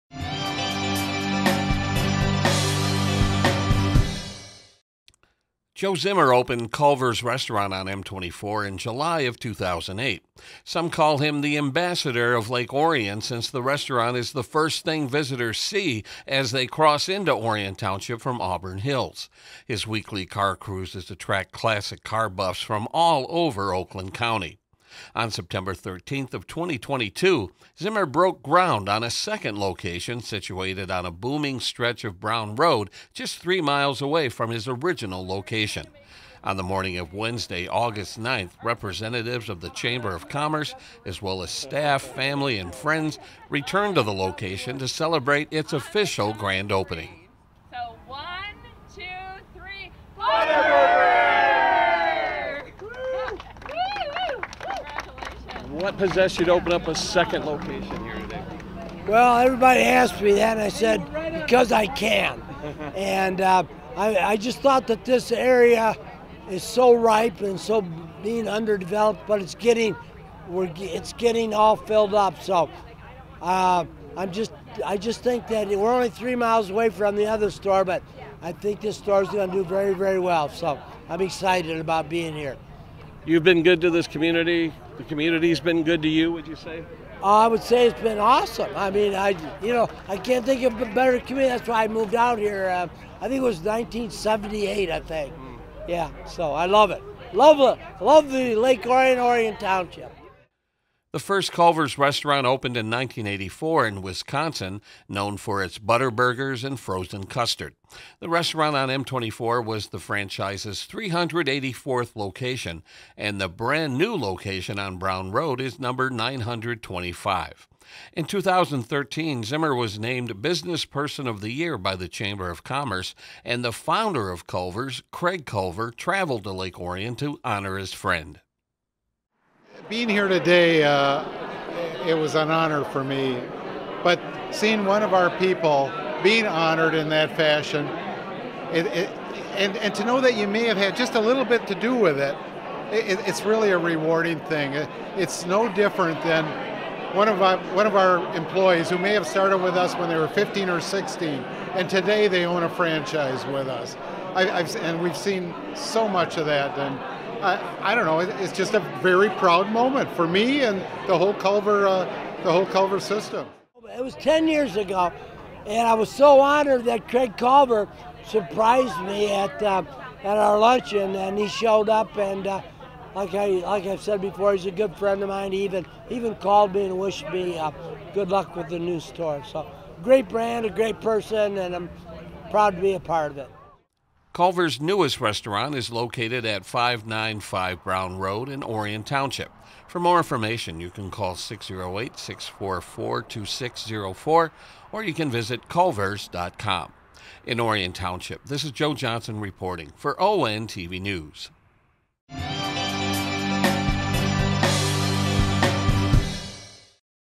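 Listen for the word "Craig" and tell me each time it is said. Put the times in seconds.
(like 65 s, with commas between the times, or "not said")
125 s, 167 s.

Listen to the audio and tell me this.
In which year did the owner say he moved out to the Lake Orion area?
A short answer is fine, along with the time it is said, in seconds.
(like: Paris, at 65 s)
1978, at 93 s.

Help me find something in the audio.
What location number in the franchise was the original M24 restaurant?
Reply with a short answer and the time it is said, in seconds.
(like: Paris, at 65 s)
384th, at 110 s.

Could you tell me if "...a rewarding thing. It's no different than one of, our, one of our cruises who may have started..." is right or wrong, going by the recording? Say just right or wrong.
wrong.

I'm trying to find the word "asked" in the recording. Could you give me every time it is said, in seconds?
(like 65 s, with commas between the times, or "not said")
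59 s.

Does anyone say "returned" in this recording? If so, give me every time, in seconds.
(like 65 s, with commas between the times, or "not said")
43 s.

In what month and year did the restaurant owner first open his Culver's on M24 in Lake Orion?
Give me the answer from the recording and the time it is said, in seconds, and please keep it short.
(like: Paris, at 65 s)
July 2008, at 8 s.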